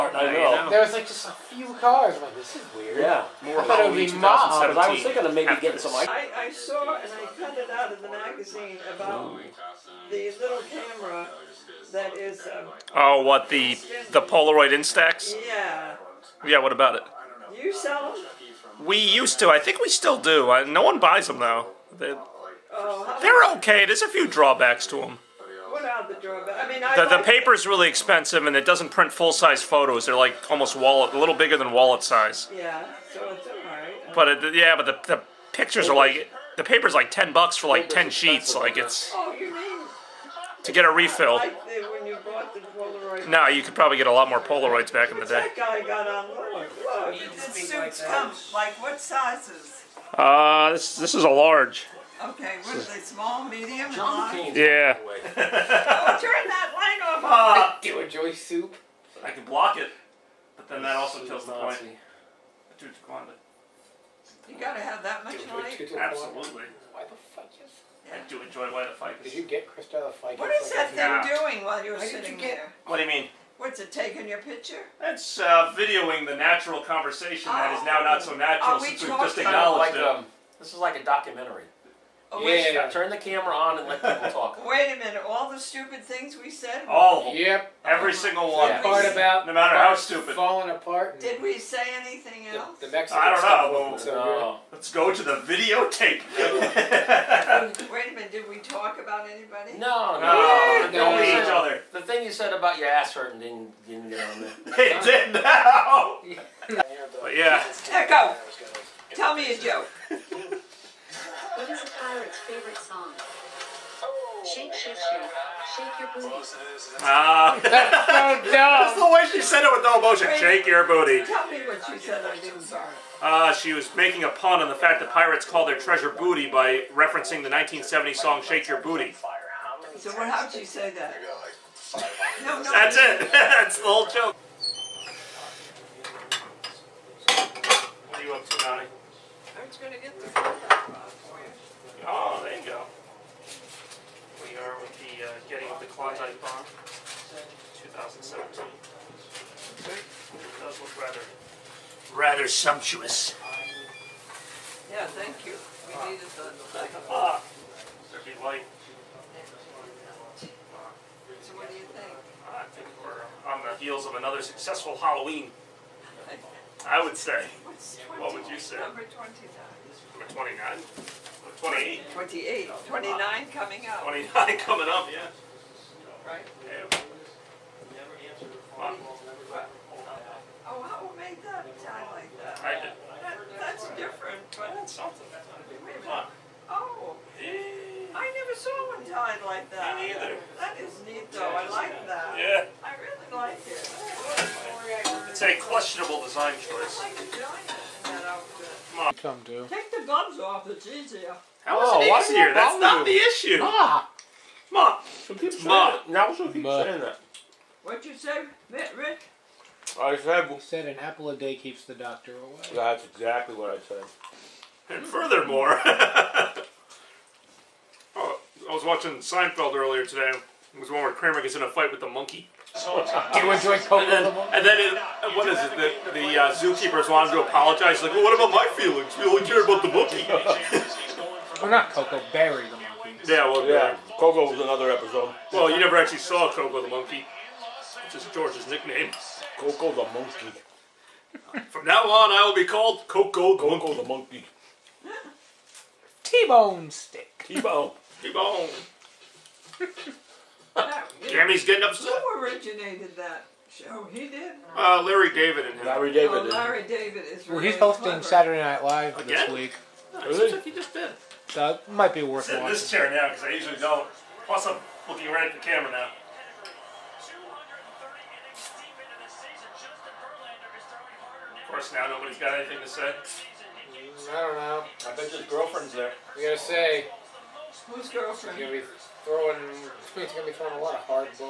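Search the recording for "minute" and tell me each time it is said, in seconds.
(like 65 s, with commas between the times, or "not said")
84 s, 98 s.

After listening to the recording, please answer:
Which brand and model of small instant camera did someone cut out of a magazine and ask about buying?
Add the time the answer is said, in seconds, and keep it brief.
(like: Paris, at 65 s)
Polaroid Instax, at 14 s.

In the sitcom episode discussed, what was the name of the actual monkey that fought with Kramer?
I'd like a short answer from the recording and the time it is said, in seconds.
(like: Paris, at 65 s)
Barry, at 232 s.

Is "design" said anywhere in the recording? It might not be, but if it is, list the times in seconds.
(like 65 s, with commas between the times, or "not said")
196 s.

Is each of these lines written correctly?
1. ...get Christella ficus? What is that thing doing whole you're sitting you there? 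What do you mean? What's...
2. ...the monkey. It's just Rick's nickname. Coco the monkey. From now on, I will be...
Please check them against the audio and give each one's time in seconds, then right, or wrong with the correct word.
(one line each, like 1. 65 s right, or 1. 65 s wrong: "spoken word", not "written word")
1. 69 s wrong: "while", not "whole"
2. 236 s wrong: "George", not "Rick".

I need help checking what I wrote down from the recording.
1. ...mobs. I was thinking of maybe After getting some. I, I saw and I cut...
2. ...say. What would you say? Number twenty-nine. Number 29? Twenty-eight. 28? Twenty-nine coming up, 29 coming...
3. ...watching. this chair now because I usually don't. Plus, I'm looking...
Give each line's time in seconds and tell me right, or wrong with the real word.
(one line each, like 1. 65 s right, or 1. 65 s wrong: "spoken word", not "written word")
1. 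4 s right
2. 167 s right
3. 262 s right.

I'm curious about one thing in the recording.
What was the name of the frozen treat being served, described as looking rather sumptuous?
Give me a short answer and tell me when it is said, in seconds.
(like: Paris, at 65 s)
Klondike Bomb, at 145 s.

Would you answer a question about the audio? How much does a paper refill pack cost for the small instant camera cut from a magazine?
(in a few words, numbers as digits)
10 bucks.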